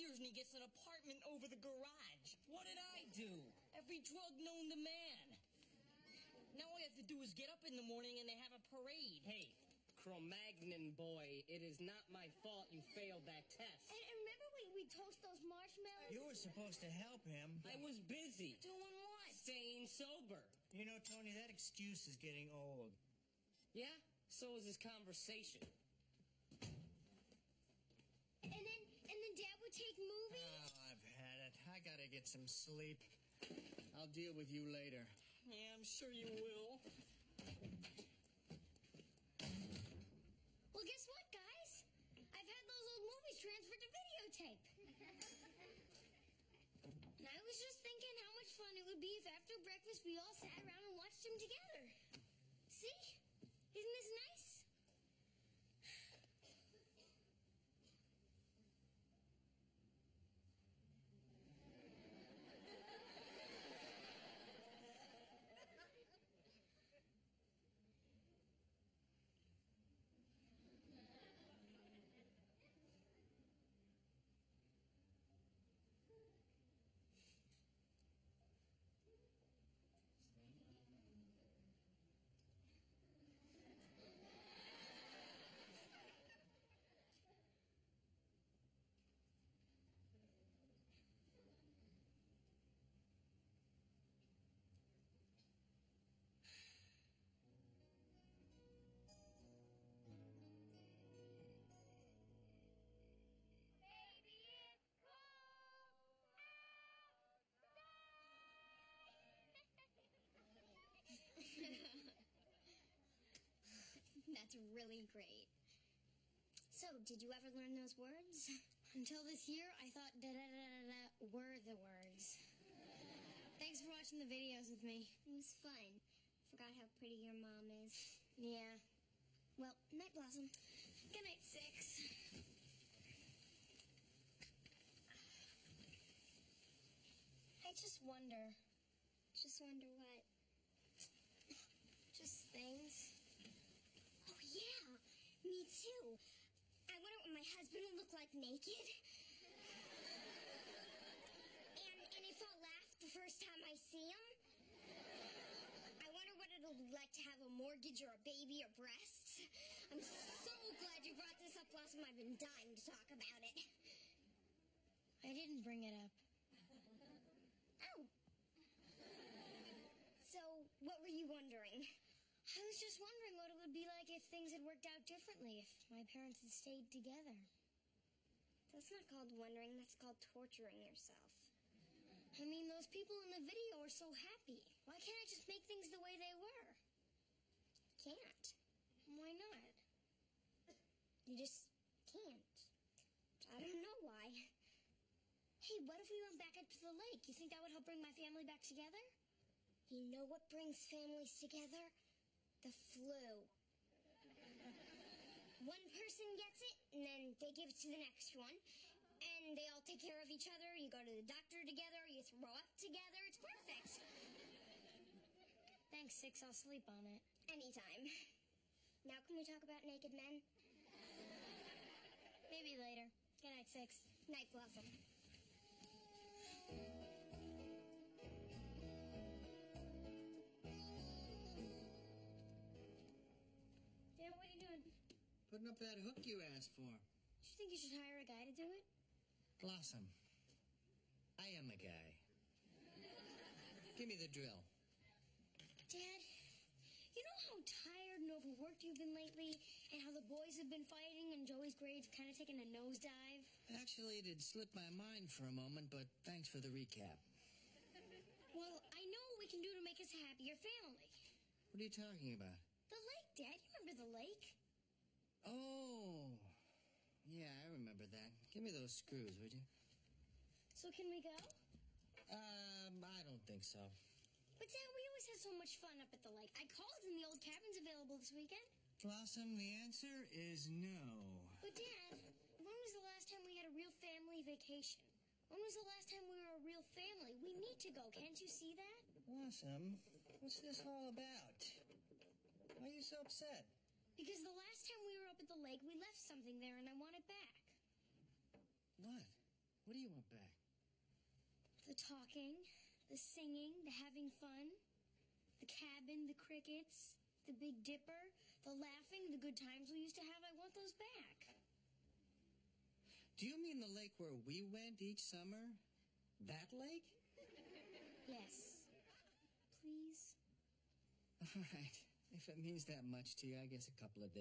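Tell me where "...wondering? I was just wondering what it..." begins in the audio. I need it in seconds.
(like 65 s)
171 s.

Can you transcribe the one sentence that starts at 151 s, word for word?
and, and if I'll laugh the first time I see him.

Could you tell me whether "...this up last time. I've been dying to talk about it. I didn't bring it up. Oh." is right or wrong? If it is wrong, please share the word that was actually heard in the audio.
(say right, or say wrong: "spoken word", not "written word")
right.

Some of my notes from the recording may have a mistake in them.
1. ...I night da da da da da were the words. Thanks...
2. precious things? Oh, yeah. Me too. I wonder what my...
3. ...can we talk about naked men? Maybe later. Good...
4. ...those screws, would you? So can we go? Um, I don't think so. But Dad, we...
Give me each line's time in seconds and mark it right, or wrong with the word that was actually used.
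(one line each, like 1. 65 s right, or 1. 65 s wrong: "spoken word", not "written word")
1. 119 s wrong: "thought", not "night"
2. 142 s right
3. 219 s right
4. 268 s right.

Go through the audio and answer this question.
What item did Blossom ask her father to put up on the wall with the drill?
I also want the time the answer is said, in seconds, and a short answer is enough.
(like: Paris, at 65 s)
hook, at 235 s.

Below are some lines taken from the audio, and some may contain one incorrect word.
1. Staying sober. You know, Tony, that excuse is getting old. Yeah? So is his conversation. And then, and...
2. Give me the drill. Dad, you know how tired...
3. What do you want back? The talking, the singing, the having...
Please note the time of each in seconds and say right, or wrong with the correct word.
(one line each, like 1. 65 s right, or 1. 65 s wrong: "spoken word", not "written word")
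1. 19 s right
2. 243 s right
3. 299 s right.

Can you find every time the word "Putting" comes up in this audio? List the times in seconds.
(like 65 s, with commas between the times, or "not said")
235 s.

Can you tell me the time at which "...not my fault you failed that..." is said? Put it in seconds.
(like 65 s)
11 s.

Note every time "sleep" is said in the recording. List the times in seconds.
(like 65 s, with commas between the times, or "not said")
32 s, 216 s.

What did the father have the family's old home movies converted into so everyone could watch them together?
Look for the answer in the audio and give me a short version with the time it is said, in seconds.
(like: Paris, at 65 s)
videotape, at 43 s.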